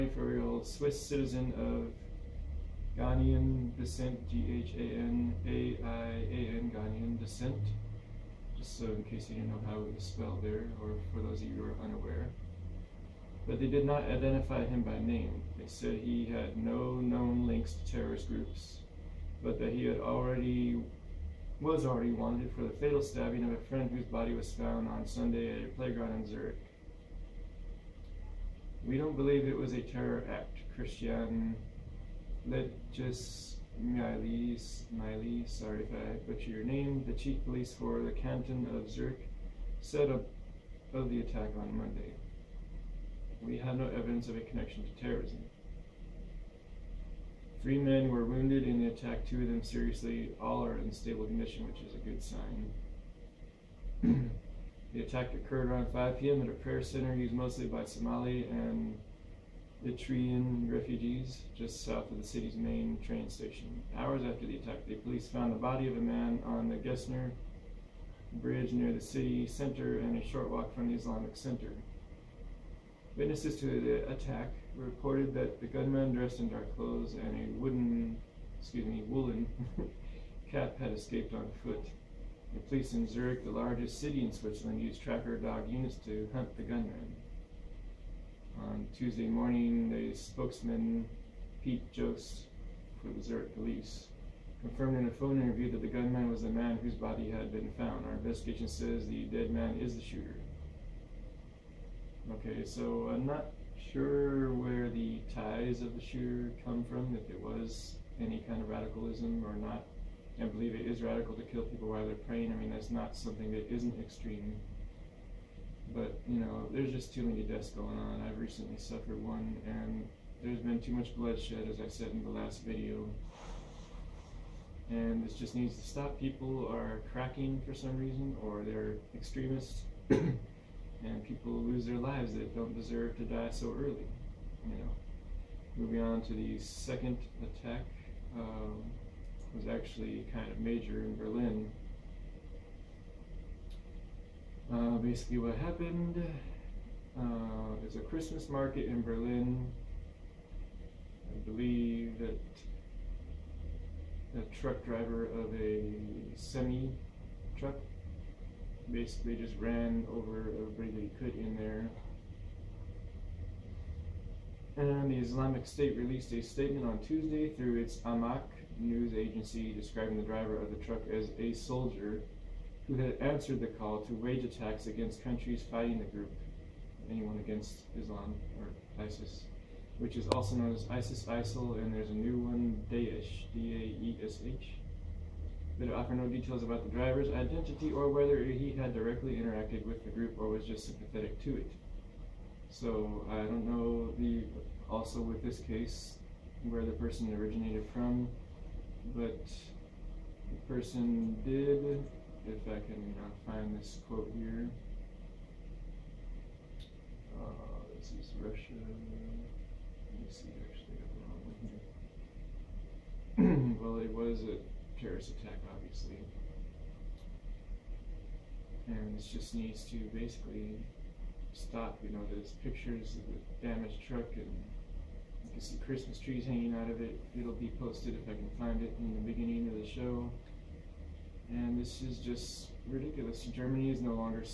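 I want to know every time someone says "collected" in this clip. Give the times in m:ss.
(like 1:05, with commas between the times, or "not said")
not said.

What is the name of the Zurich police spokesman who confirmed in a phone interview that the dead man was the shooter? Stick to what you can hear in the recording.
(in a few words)
Pete Jost.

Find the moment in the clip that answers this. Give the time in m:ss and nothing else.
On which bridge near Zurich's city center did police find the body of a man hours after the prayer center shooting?
1:06.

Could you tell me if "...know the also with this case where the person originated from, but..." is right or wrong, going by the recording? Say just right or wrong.
right.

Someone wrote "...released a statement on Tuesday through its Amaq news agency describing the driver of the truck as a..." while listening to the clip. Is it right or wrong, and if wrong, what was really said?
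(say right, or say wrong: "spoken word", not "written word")
right.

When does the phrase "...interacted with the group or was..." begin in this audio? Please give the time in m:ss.
3:09.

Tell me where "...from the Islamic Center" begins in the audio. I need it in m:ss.
1:10.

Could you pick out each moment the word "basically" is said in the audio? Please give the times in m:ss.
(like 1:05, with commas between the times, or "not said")
2:24, 2:38, 3:40.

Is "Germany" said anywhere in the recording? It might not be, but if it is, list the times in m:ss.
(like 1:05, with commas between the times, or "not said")
3:53.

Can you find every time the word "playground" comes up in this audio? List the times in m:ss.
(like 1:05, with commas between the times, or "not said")
0:25.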